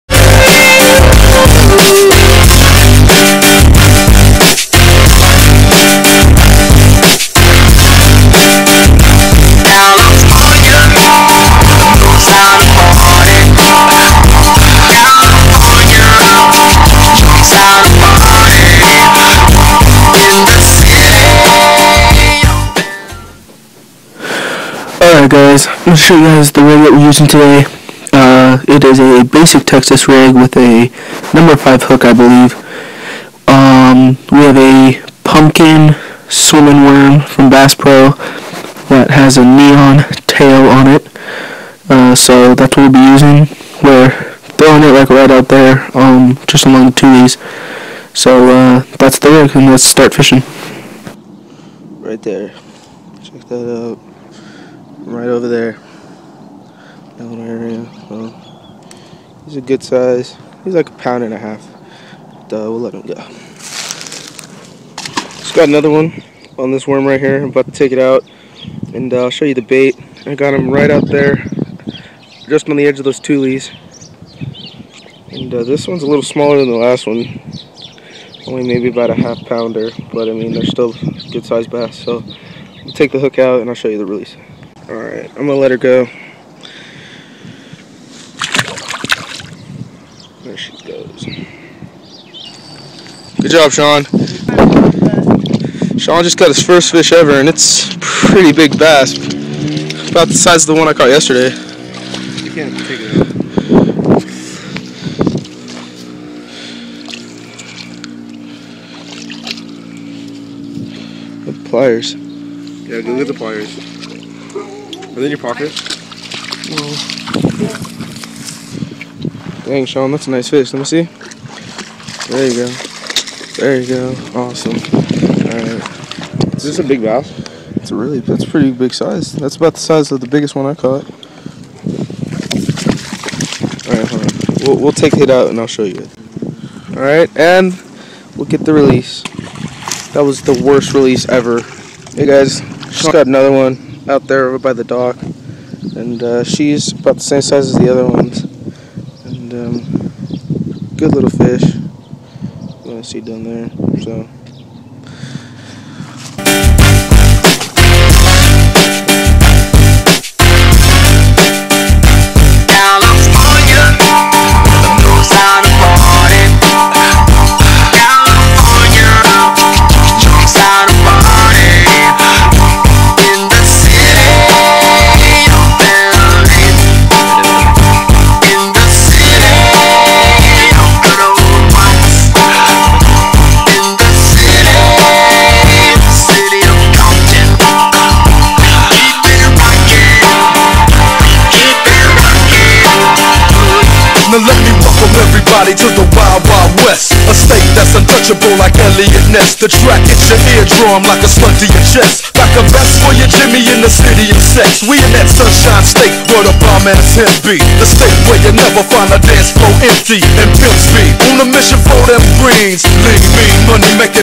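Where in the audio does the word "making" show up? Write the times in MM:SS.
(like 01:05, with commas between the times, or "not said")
03:34.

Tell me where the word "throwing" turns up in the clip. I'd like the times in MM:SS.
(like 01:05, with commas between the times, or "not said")
00:44.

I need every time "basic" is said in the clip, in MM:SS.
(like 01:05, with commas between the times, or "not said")
00:29.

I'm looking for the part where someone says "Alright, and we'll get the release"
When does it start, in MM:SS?
02:16.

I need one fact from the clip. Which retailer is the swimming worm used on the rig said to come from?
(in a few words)
Bass Pro.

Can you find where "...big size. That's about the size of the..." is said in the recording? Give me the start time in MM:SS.
02:08.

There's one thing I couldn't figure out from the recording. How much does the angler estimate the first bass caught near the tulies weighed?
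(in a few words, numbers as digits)
a pound and a half.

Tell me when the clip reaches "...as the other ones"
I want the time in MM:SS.
02:27.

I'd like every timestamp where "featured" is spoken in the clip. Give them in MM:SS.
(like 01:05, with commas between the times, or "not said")
not said.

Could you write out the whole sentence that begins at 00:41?
Uh, so that's what we'll be using.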